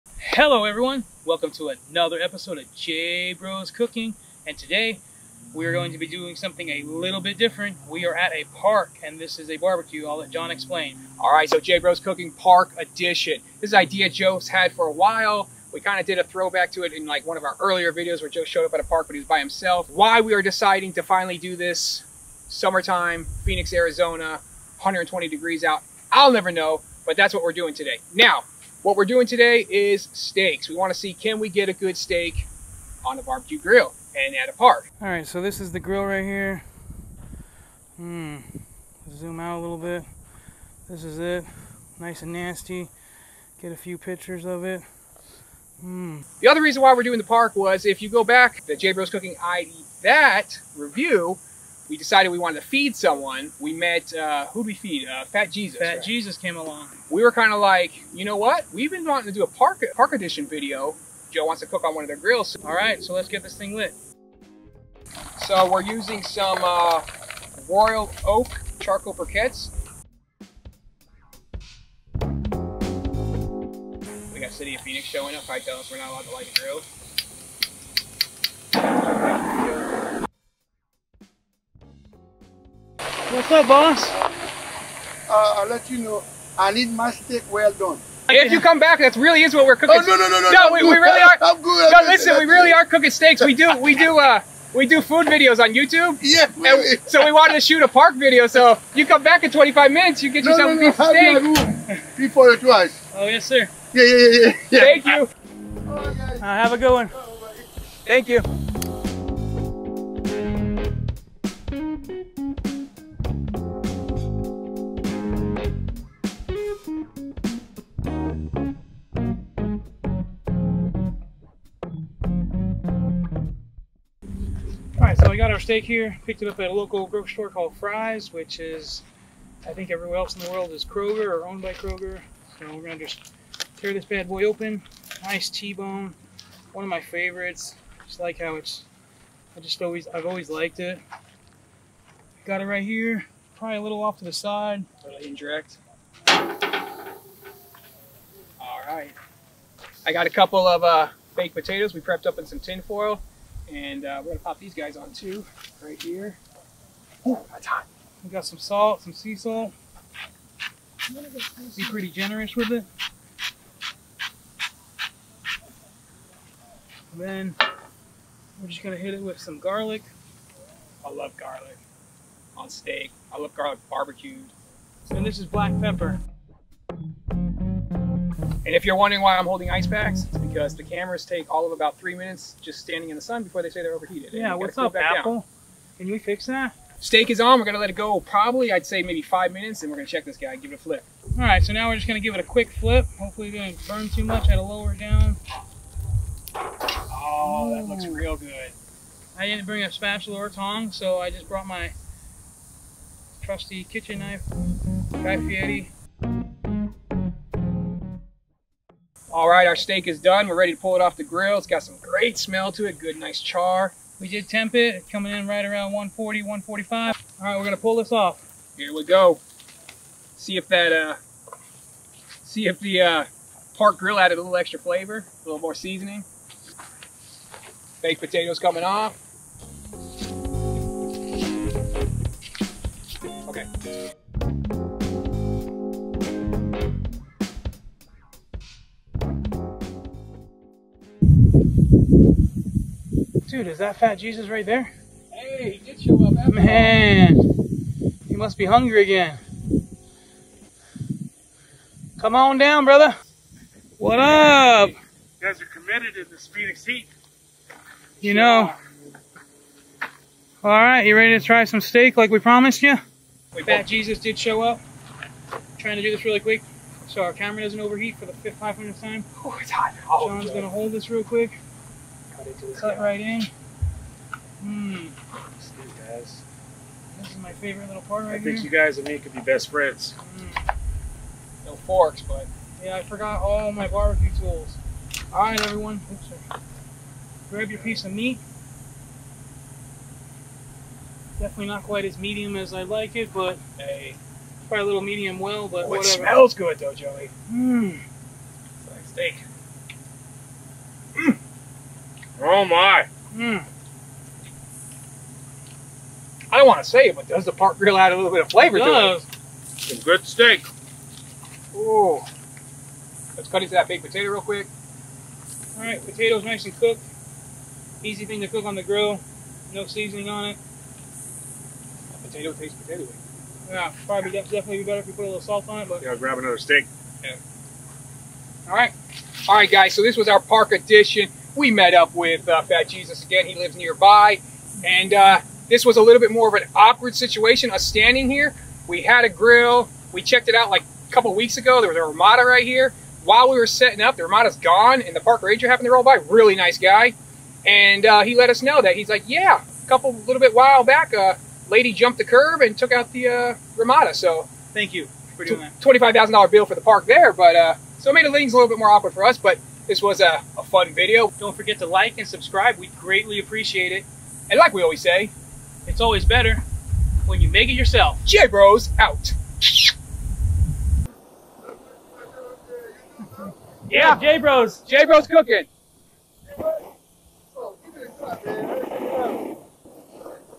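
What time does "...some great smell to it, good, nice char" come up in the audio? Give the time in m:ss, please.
3:31.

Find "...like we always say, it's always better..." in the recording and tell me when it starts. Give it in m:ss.
6:04.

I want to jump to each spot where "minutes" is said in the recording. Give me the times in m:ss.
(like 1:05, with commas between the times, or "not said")
1:39, 3:02, 3:09.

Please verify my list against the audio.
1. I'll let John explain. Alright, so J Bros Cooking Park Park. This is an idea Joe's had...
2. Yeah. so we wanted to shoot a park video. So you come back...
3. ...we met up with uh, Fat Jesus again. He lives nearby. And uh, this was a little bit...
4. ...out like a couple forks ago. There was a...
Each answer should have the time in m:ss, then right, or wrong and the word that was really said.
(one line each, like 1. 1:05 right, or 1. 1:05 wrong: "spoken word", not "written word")
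1. 0:10 wrong: "Edition", not "Park"
2. 1:36 right
3. 5:31 right
4. 5:40 wrong: "weeks", not "forks".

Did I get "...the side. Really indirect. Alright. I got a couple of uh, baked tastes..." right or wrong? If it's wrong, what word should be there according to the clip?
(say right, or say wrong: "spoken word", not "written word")
wrong: "potatoes", not "tastes".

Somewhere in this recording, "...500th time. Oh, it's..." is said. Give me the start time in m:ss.
4:28.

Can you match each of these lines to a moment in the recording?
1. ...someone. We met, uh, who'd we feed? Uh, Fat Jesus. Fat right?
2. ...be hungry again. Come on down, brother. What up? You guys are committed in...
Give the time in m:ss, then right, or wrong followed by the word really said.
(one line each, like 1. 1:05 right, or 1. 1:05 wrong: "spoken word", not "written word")
1. 0:52 right
2. 4:08 right.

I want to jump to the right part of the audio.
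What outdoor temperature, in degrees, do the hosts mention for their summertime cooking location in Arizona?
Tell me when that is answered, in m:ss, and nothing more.
0:24.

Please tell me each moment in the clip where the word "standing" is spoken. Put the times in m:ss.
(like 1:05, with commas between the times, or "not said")
3:02, 5:37.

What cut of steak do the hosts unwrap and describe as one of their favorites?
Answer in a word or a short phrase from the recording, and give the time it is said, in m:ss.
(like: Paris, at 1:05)
T-bone, at 2:15.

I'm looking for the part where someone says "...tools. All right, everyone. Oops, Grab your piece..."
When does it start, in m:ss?
4:44.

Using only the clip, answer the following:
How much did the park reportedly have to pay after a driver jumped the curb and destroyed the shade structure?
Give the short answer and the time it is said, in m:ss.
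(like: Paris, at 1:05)
$25,000, at 5:55.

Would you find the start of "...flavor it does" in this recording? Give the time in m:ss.
5:08.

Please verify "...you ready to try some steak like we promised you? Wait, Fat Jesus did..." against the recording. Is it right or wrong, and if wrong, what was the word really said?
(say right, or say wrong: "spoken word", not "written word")
right.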